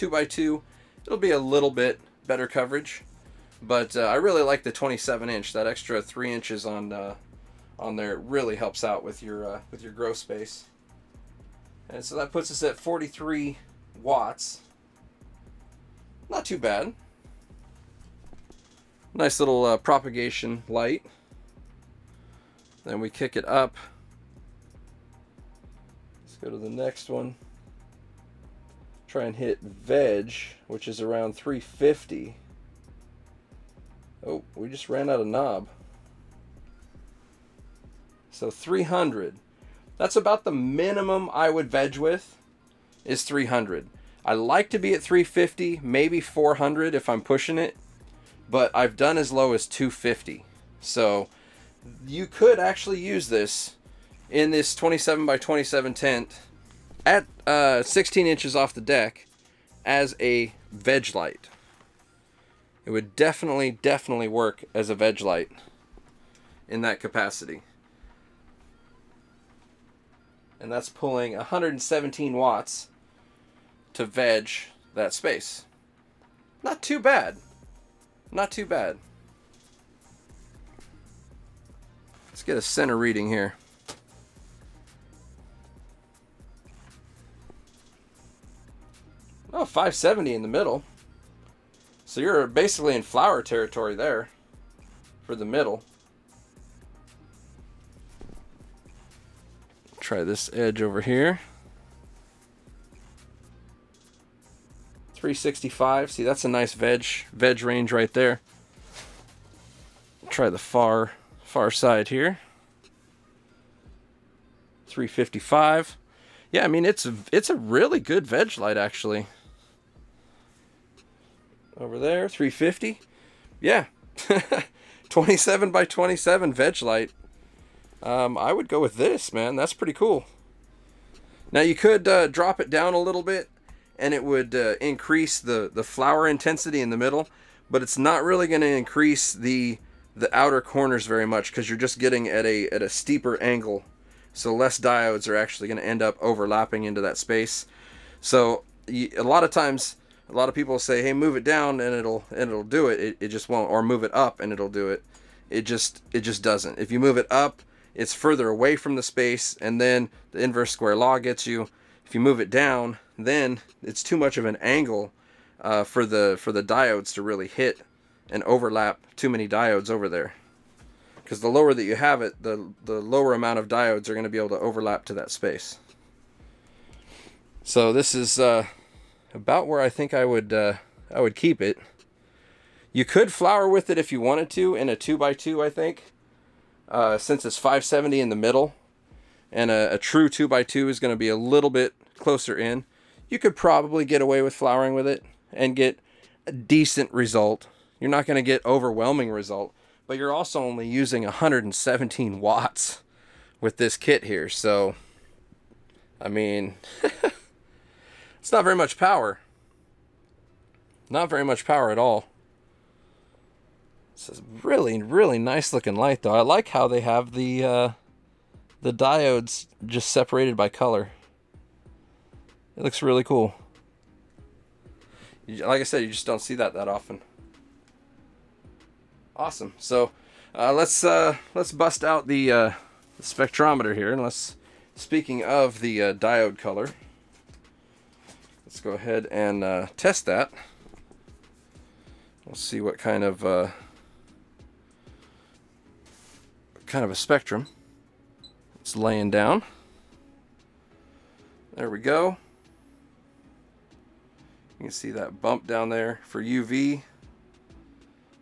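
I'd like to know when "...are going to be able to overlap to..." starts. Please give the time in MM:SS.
02:54.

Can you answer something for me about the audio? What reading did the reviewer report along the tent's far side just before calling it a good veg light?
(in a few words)
355.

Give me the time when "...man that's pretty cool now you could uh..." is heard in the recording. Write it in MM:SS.
02:09.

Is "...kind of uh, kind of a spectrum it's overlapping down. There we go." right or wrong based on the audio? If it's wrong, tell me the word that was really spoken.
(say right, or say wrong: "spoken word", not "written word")
wrong: "laying", not "overlapping".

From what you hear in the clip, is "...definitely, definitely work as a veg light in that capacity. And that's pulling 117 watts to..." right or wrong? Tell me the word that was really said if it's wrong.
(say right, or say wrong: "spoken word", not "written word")
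right.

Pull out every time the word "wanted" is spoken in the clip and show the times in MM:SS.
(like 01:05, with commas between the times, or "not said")
03:04.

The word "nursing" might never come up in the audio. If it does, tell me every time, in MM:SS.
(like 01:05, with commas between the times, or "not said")
not said.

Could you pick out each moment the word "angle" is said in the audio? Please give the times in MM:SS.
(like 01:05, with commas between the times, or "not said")
02:23, 02:44.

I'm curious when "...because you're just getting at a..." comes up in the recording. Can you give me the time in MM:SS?
02:21.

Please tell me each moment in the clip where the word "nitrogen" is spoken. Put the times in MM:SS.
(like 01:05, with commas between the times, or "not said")
not said.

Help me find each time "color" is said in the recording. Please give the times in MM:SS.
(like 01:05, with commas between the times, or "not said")
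03:40, 03:56.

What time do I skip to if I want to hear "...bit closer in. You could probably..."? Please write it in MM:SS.
03:11.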